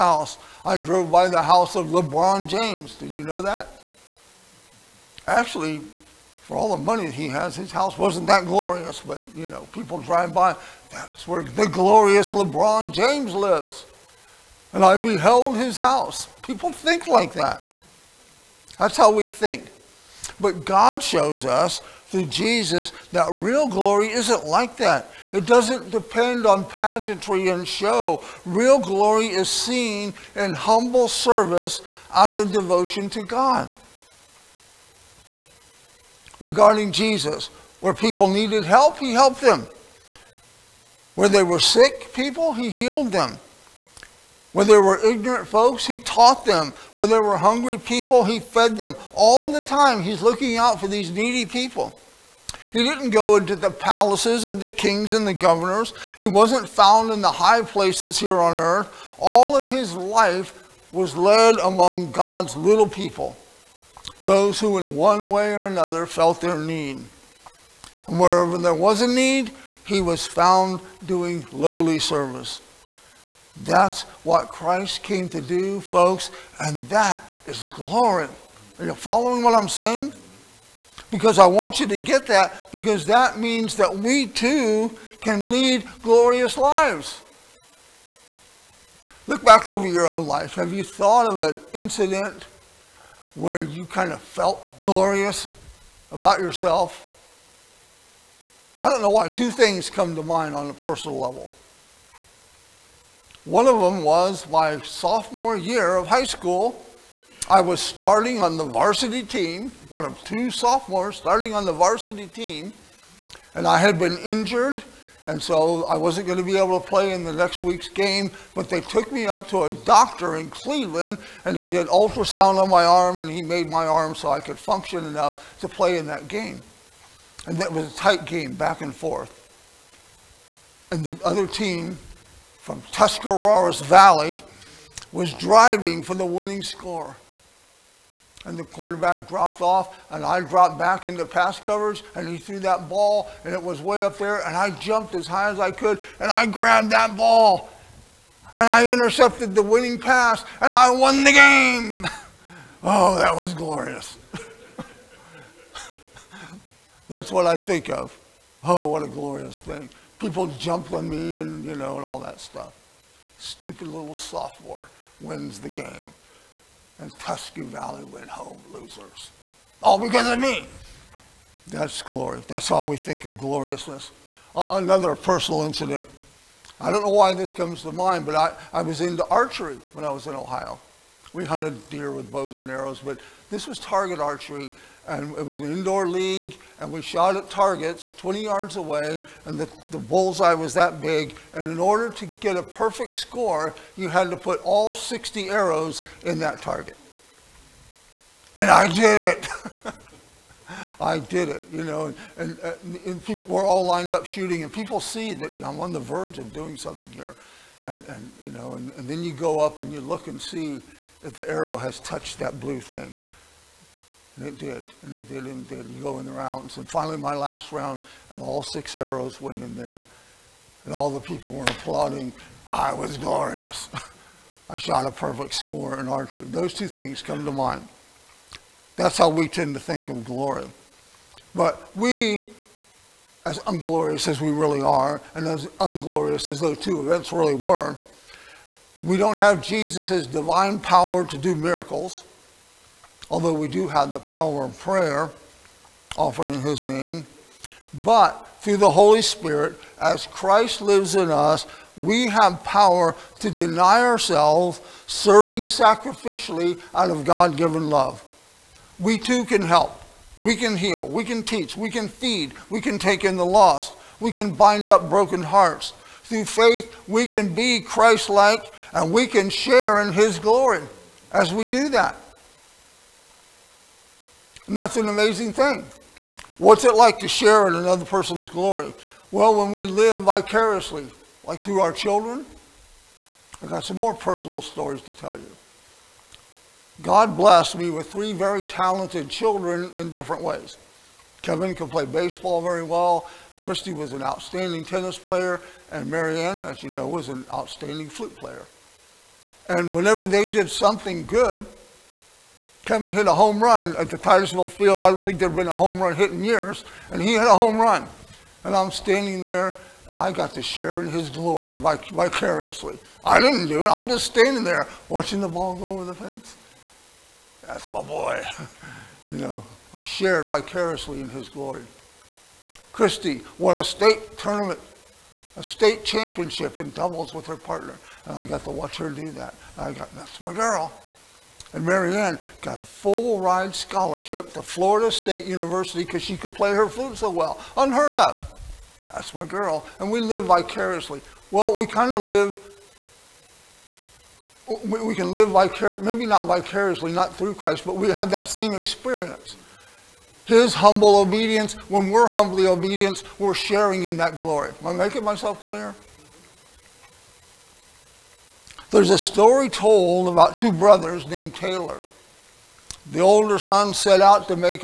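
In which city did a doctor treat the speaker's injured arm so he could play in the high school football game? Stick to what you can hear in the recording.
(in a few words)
Cleveland.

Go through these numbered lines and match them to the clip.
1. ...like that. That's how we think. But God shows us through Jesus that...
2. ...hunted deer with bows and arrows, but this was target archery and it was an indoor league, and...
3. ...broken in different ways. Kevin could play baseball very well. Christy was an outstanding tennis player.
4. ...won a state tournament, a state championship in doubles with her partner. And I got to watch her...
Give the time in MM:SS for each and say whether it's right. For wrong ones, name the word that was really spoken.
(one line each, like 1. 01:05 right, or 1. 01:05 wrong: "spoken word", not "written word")
1. 00:17 right
2. 03:01 right
3. 04:49 wrong: "children", not "broken"
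4. 05:23 right.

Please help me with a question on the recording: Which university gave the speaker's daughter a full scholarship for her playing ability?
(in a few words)
Florida State University.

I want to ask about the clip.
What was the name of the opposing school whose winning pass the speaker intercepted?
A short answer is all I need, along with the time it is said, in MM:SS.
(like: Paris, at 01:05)
Tuscarawas Valley, at 02:12.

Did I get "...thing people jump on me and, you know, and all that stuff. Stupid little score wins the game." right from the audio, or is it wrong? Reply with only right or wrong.
wrong.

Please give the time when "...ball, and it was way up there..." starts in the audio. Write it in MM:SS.
02:22.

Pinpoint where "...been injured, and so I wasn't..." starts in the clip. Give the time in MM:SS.
01:53.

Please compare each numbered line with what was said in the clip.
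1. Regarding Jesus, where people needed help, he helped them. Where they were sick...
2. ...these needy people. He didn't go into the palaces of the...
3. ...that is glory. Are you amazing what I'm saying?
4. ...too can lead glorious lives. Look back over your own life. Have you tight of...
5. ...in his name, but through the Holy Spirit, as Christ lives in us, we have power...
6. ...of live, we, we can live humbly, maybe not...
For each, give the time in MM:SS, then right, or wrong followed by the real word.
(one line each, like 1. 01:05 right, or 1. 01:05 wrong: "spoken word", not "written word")
1. 00:36 right
2. 00:50 right
3. 01:16 wrong: "following", not "amazing"
4. 01:24 wrong: "thought", not "tight"
5. 04:06 right
6. 05:42 wrong: "vicariously", not "humbly".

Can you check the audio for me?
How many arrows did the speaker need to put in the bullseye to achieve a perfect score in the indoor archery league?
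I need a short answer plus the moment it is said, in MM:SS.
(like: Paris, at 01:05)
60, at 03:14.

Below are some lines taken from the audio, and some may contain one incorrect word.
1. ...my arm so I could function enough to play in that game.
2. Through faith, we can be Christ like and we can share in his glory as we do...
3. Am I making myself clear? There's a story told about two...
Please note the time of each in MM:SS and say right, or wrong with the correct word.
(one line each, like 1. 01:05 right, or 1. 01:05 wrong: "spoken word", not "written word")
1. 02:03 right
2. 04:26 right
3. 05:54 right.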